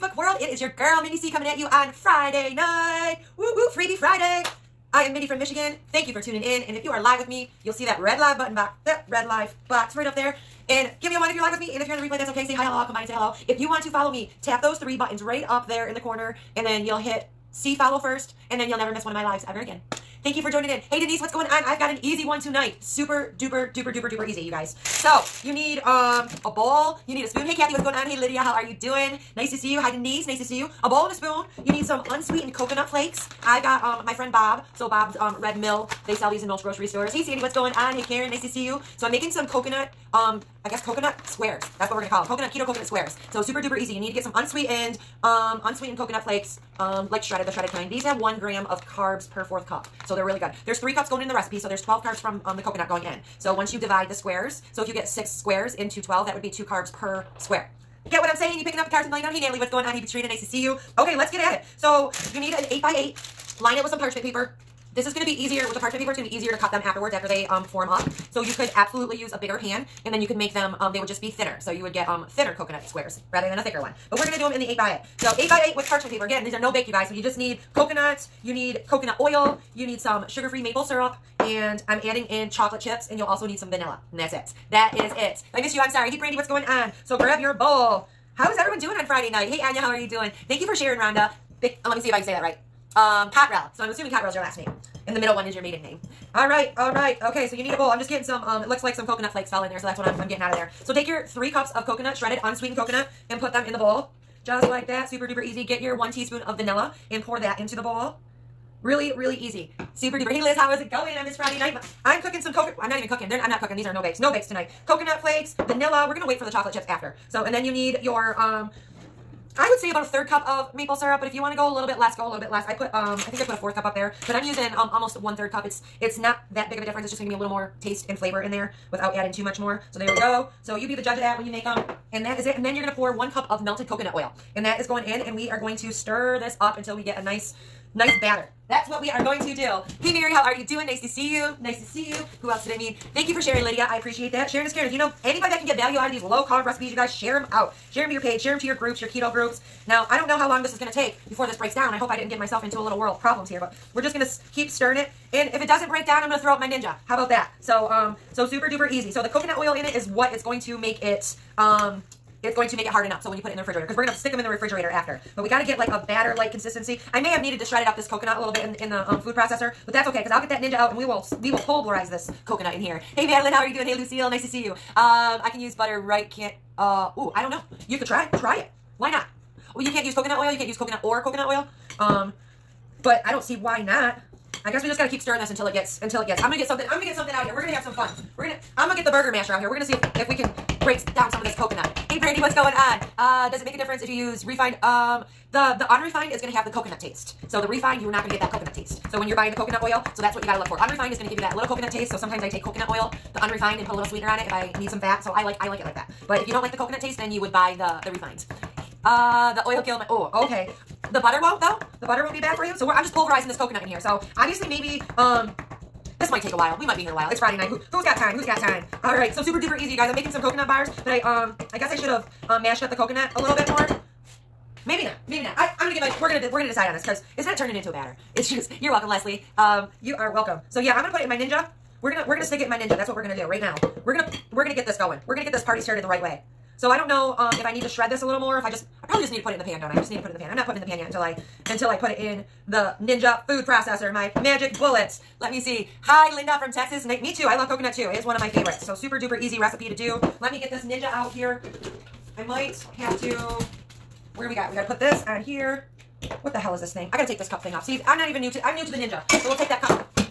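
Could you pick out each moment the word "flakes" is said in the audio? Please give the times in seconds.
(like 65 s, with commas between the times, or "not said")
32 s, 46 s, 99 s, 115 s.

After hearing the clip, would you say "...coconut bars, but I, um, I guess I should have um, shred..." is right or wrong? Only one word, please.
wrong.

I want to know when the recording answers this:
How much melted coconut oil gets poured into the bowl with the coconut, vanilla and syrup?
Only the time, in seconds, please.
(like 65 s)
133 s.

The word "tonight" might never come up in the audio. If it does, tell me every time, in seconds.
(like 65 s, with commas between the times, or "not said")
22 s, 114 s.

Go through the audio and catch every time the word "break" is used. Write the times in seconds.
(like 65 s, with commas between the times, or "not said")
151 s, 155 s, 190 s.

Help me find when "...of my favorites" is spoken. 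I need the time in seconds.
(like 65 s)
248 s.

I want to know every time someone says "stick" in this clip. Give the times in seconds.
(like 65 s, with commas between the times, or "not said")
164 s, 232 s.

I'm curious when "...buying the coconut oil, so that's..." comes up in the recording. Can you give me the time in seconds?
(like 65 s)
199 s.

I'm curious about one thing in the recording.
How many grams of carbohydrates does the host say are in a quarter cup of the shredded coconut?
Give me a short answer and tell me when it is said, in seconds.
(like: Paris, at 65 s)
1 gram, at 48 s.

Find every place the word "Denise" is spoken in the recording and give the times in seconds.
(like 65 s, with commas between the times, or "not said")
20 s, 29 s.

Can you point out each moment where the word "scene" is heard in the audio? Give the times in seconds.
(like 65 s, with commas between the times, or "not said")
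not said.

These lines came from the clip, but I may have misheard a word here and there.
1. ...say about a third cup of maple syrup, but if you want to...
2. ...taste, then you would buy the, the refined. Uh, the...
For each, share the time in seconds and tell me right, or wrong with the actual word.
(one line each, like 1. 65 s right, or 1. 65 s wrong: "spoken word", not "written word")
1. 119 s right
2. 206 s right.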